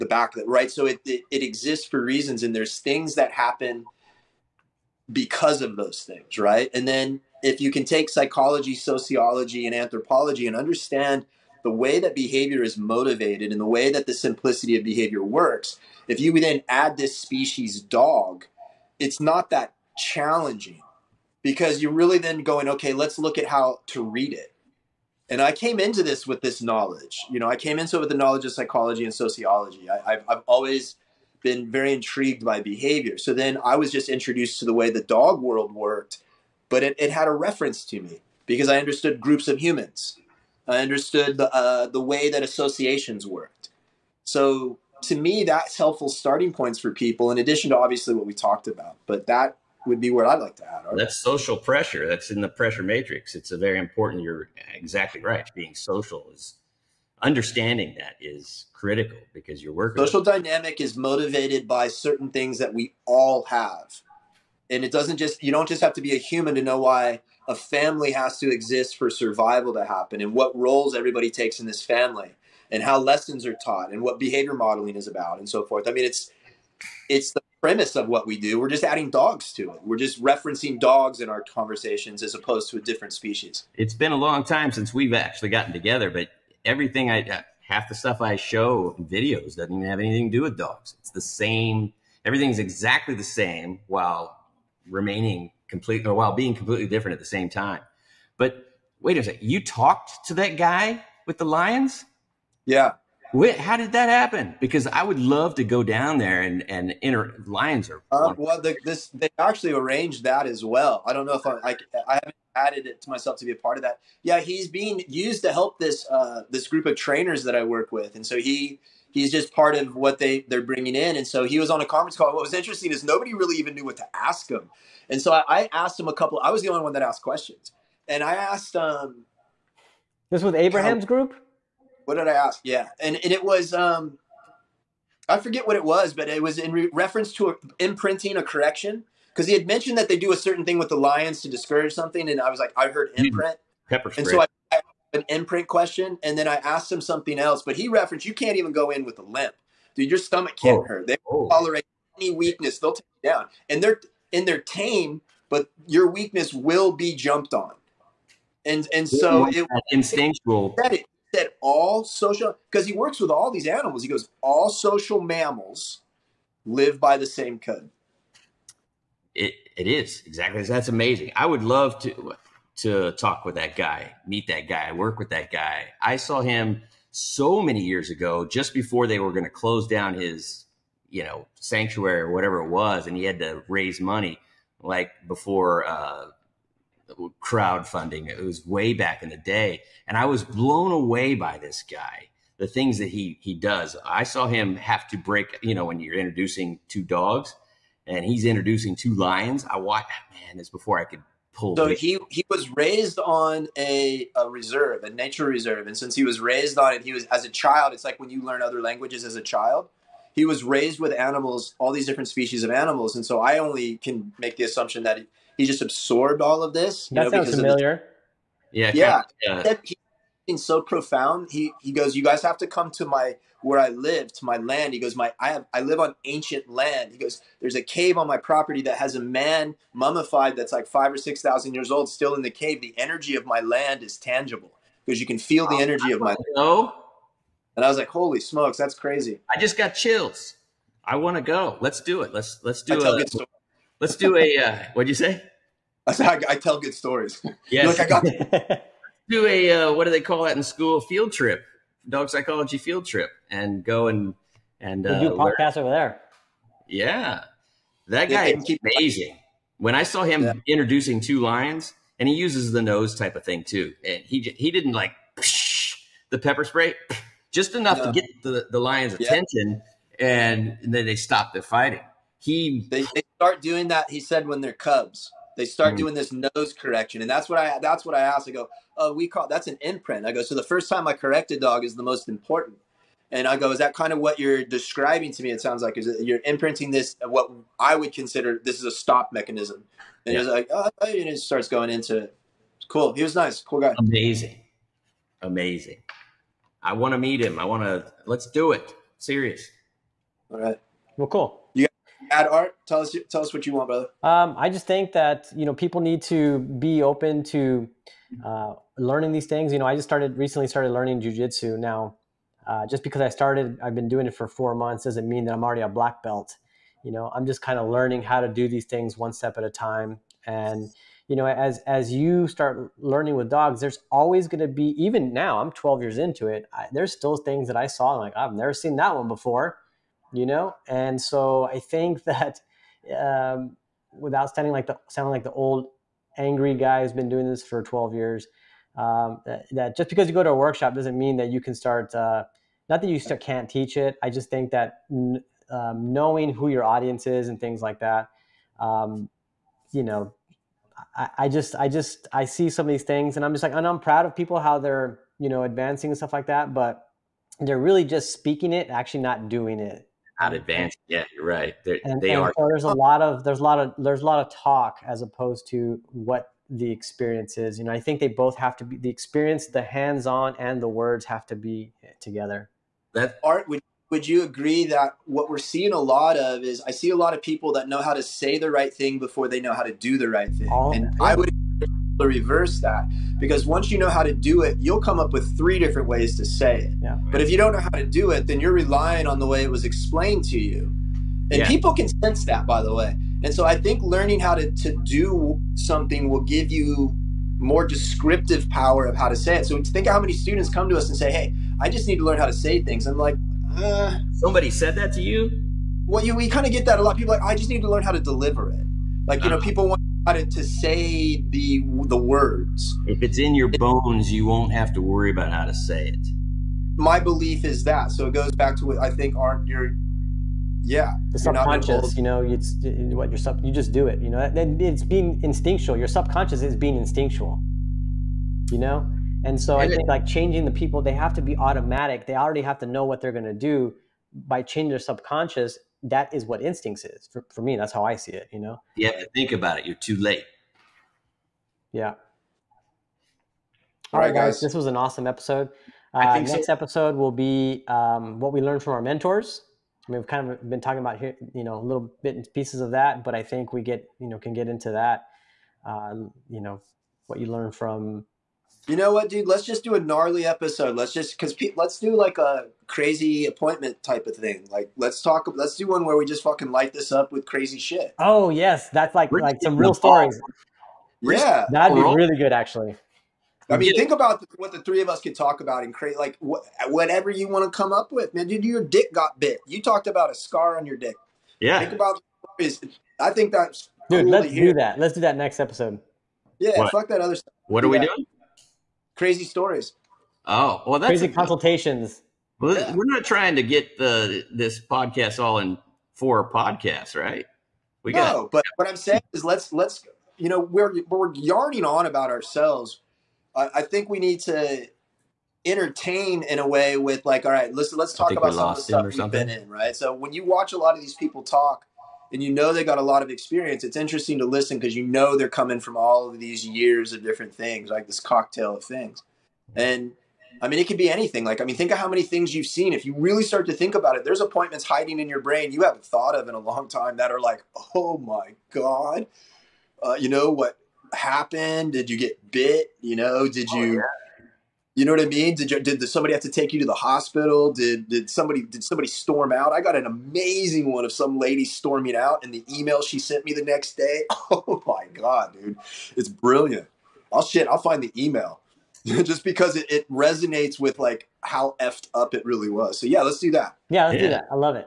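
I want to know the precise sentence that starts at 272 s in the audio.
He they, they start doing that.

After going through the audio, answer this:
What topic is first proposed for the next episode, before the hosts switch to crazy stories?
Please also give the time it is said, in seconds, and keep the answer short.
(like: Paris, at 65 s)
what we learned from our mentors, at 448 s.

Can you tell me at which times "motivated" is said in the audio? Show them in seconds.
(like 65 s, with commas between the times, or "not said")
12 s, 60 s.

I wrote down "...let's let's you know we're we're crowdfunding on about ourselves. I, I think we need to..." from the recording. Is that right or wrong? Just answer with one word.
wrong.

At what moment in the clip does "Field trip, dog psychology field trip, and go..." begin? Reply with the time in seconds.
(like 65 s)
251 s.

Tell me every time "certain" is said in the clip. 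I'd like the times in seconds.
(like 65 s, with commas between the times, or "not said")
61 s, 140 s.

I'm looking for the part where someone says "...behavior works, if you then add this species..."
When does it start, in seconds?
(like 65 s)
14 s.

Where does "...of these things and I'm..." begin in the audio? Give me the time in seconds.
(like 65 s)
352 s.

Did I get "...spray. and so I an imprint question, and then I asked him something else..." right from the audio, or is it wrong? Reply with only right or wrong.
right.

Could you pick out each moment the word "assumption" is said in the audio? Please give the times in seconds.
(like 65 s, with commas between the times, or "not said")
214 s.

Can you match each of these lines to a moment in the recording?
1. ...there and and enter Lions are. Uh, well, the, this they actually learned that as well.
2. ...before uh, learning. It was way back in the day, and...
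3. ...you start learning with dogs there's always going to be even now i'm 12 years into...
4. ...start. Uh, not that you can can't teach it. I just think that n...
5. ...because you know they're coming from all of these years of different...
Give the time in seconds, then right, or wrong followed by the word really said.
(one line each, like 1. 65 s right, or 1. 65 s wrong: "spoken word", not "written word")
1. 106 s wrong: "arranged", not "learned"
2. 185 s wrong: "crowdfunding", not "learning"
3. 322 s right
4. 341 s right
5. 514 s right.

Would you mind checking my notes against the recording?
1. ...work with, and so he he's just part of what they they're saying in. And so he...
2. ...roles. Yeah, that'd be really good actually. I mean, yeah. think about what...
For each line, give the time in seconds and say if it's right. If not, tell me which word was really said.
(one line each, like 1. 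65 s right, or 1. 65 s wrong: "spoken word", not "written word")
1. 117 s wrong: "bringing", not "saying"
2. 469 s wrong: "stories", not "roles".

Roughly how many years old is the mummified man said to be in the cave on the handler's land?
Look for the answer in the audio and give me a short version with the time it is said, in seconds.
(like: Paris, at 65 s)
5 or 6,000, at 230 s.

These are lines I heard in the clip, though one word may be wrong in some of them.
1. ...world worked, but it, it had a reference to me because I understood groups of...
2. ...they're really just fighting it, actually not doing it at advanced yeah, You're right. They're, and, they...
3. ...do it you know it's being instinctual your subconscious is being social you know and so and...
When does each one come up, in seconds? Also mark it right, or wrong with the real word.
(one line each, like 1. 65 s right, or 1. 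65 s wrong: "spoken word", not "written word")
1. 35 s right
2. 357 s wrong: "speaking", not "fighting"
3. 423 s wrong: "instinctual", not "social".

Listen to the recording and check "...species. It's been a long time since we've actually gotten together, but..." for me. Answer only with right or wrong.
right.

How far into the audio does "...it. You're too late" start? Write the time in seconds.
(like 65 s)
439 s.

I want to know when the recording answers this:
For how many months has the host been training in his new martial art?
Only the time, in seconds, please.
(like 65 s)
314 s.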